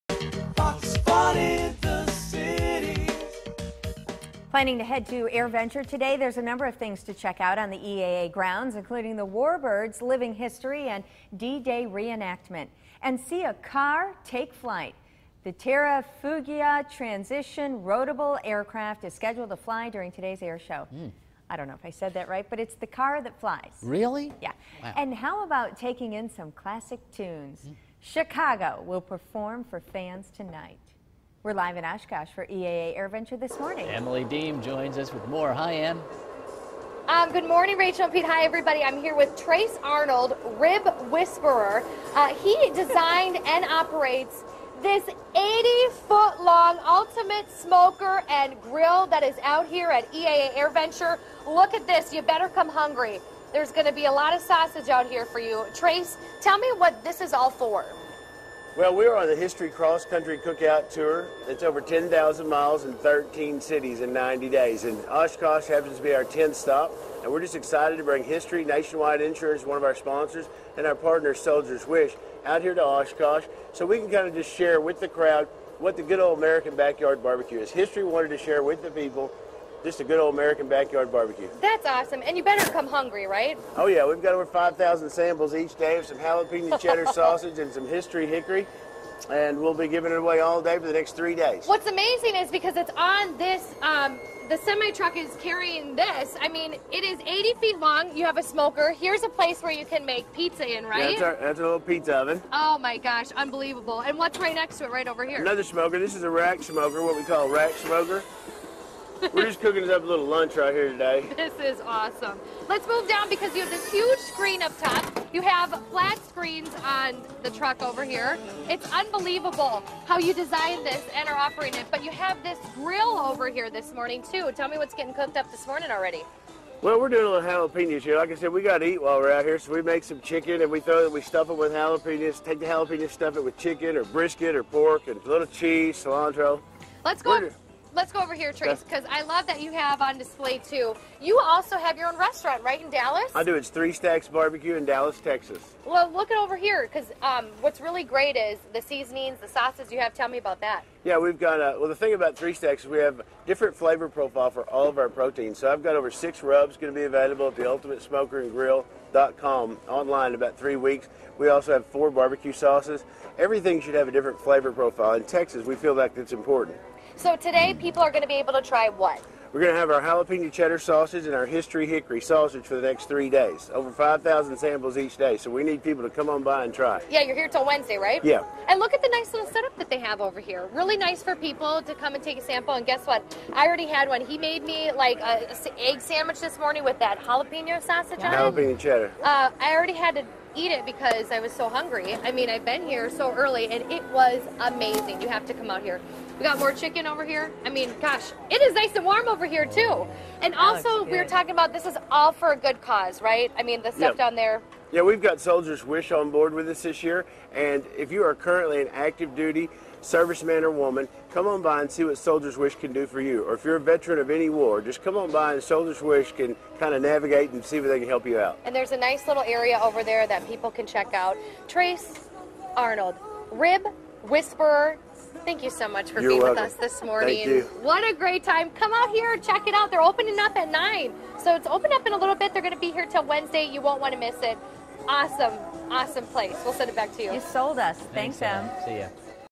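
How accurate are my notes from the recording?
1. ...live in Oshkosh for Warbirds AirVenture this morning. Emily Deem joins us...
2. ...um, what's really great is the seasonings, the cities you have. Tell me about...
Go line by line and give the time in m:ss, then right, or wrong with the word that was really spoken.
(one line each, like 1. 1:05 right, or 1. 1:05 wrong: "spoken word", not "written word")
1. 0:31 wrong: "EAA", not "Warbirds"
2. 2:27 wrong: "sauces", not "cities".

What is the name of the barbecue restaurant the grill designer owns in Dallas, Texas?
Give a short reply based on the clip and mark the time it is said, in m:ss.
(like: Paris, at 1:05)
Three Stacks Barbecue, at 2:23.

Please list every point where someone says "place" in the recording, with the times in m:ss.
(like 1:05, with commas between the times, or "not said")
1:39, 3:56.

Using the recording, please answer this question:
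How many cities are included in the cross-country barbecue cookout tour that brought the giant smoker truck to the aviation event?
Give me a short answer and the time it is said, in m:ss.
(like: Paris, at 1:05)
13, at 1:02.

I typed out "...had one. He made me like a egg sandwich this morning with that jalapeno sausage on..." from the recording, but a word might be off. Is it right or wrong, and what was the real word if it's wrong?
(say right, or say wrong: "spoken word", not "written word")
right.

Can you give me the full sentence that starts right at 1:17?
History wanted to share with the people just a good old American backyard barbecue.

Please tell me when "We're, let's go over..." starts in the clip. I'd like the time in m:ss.
2:17.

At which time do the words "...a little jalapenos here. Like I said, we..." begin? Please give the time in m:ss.
2:07.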